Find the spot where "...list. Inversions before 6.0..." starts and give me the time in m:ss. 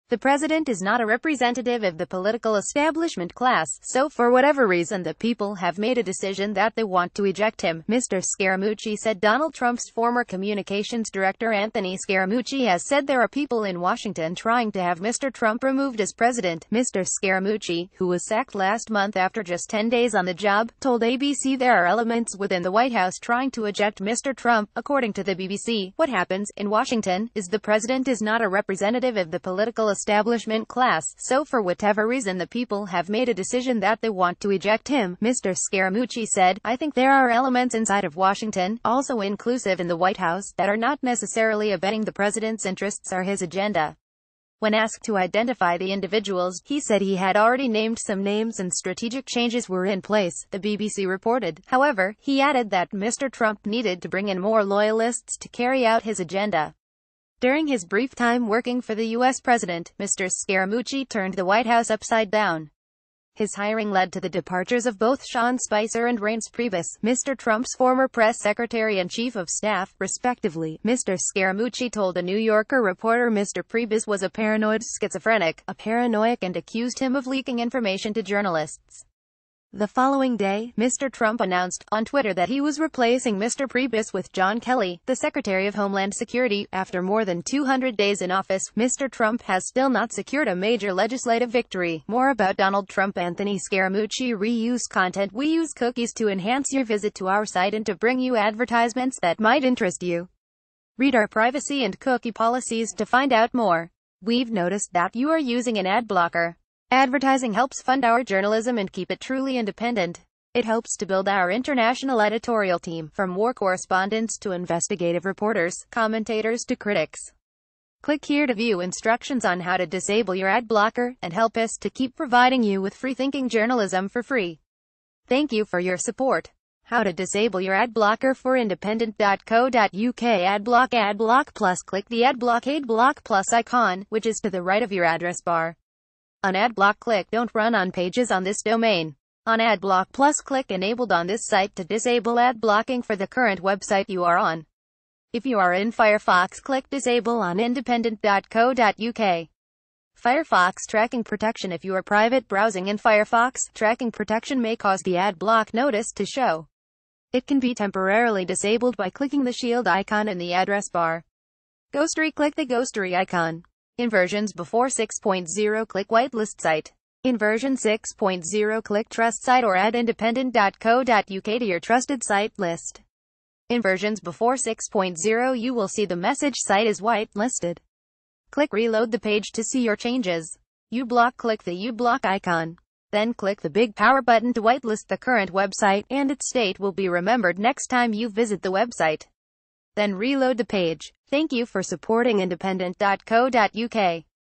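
2:52.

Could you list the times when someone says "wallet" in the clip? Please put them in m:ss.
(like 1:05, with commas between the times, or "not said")
not said.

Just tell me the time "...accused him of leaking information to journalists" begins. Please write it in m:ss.
1:16.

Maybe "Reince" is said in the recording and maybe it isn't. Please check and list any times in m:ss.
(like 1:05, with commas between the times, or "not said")
1:06.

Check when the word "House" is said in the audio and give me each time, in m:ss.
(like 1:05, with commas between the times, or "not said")
0:22, 0:40, 1:01.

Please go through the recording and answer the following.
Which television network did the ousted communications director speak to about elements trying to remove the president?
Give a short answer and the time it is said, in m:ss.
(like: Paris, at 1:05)
ABC, at 0:21.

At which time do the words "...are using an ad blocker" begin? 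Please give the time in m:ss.
1:45.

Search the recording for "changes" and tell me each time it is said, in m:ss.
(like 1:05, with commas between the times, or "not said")
0:49, 2:59.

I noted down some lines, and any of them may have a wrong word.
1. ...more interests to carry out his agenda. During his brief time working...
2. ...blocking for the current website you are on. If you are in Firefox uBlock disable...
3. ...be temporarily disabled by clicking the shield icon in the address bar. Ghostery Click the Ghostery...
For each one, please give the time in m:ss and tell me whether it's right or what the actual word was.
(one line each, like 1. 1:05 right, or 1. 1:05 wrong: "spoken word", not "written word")
1. 0:54 wrong: "loyalists", not "interests"
2. 2:22 wrong: "click", not "uBlock"
3. 2:37 right.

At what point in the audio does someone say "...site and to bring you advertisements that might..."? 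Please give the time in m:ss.
1:37.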